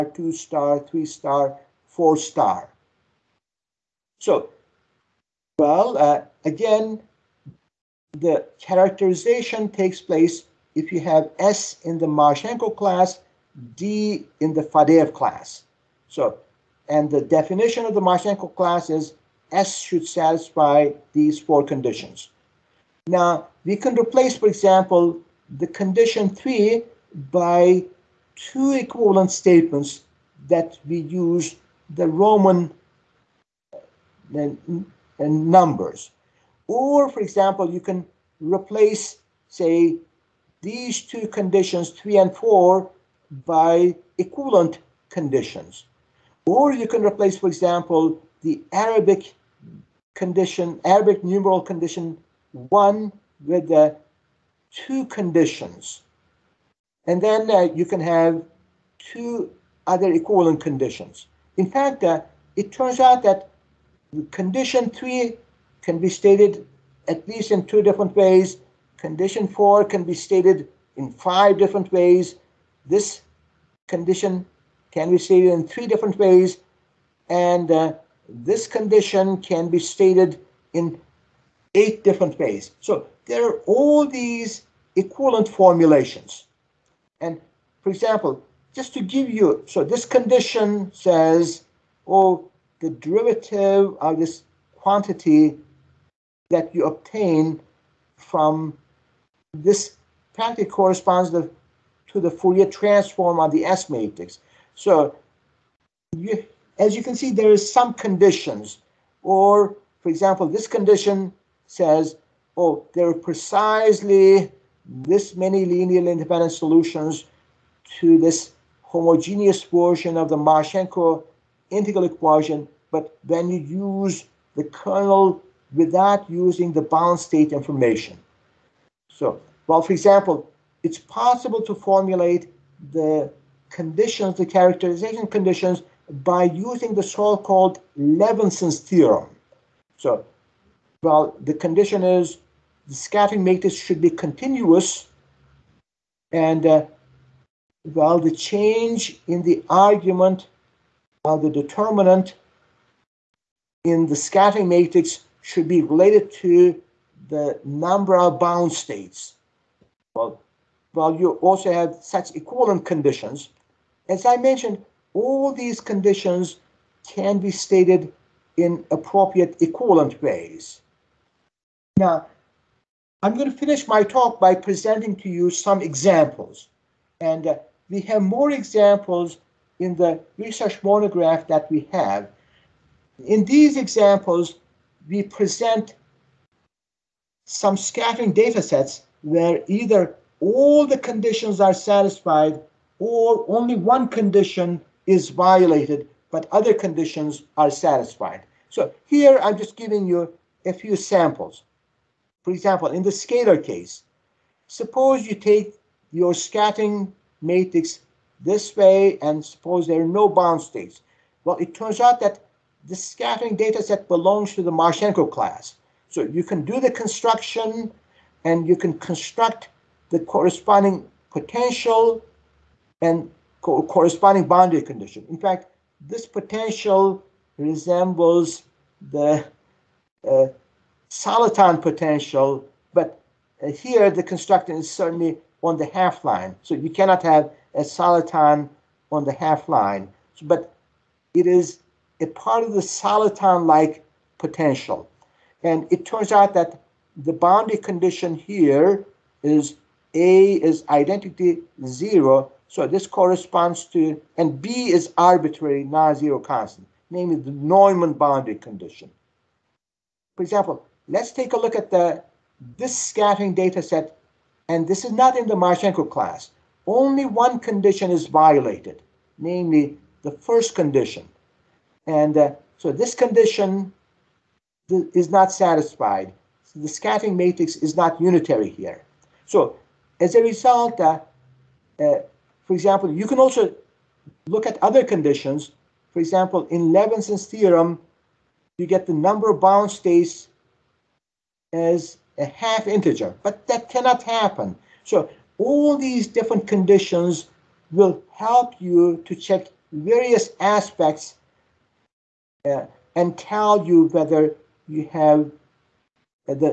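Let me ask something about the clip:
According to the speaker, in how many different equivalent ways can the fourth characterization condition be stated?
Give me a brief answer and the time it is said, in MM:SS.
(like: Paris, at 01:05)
5, at 01:11.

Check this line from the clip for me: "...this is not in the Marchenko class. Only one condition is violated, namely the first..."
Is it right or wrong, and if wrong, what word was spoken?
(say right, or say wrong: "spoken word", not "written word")
right.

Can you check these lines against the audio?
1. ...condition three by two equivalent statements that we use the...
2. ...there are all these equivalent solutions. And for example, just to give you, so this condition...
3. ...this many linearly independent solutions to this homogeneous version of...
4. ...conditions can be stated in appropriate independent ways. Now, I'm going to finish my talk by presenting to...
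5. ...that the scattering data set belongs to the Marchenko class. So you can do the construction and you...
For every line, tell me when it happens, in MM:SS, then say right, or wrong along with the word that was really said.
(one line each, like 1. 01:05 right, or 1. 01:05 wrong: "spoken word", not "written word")
1. 00:25 right
2. 01:23 wrong: "formulations", not "solutions"
3. 01:54 right
4. 02:45 wrong: "equivalent", not "independent"
5. 03:32 right.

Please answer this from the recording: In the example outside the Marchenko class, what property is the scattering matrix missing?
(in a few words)
Unitary.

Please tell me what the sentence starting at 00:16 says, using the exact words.
So, and the definition of the Marchenko class is S should satisfy these four conditions.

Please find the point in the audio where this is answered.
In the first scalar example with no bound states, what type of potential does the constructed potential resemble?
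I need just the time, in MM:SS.
03:51.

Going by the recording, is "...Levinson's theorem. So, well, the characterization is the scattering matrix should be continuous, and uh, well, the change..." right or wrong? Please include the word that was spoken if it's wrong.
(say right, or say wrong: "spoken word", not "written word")
wrong: "condition", not "characterization".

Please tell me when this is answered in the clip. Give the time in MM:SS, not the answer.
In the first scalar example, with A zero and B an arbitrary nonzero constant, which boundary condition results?
04:17.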